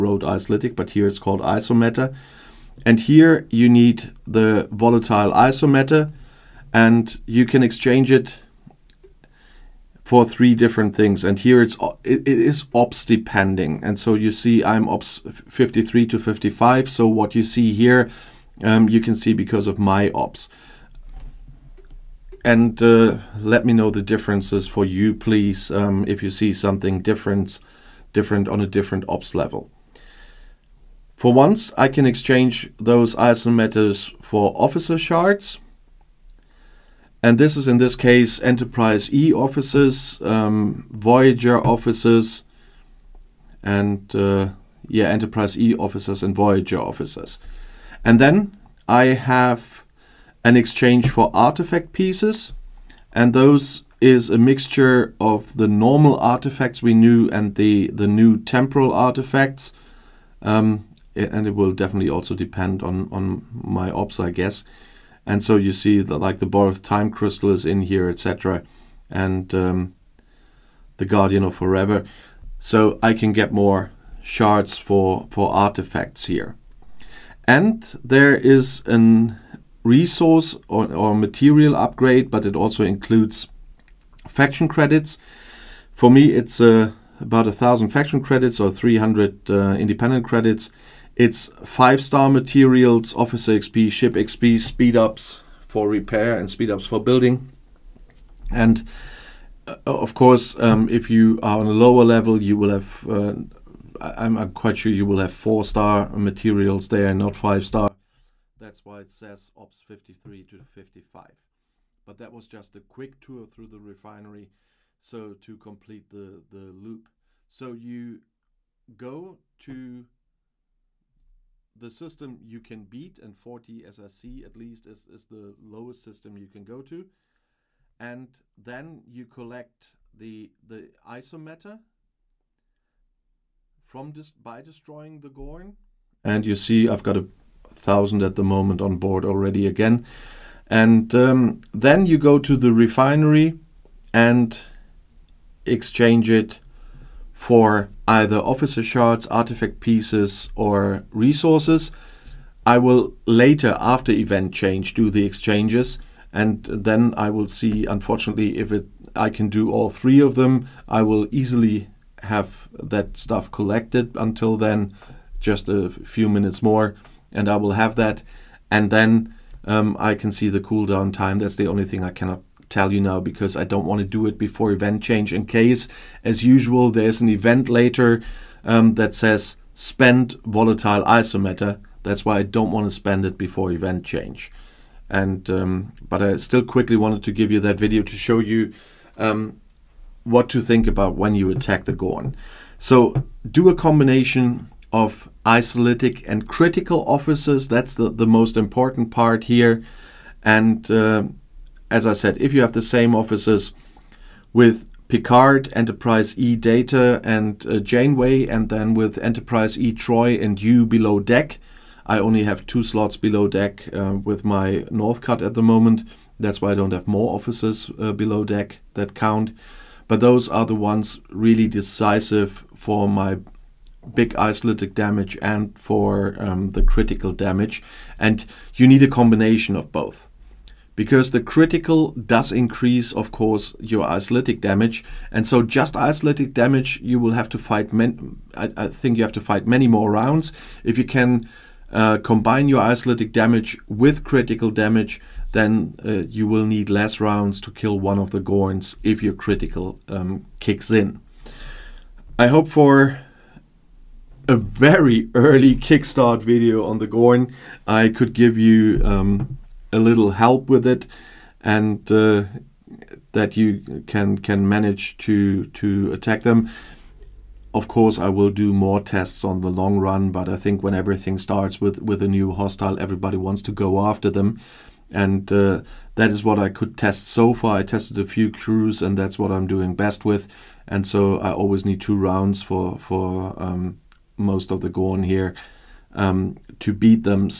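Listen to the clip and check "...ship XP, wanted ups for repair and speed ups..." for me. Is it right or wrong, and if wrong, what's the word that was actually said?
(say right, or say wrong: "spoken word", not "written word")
wrong: "speed", not "wanted".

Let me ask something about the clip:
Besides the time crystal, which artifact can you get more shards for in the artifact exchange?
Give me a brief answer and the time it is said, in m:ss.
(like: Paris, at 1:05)
Guardian of Forever, at 1:10.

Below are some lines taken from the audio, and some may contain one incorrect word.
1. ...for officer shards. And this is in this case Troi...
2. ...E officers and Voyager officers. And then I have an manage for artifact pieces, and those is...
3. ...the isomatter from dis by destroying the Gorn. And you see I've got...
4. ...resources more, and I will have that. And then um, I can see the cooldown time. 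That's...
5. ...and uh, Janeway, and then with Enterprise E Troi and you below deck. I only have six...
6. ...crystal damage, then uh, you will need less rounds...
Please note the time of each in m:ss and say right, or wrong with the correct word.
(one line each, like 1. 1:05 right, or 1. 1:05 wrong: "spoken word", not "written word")
1. 0:34 wrong: "Enterprise", not "Troi"
2. 0:45 wrong: "exchange", not "manage"
3. 2:10 right
4. 2:46 wrong: "minutes", not "resources"
5. 3:27 wrong: "two", not "six"
6. 4:04 wrong: "critical", not "crystal".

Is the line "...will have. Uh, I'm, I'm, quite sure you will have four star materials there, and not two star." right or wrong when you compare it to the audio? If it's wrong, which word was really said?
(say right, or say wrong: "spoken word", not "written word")
wrong: "five", not "two".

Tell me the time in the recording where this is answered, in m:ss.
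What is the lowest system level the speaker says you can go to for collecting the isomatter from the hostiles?
2:03.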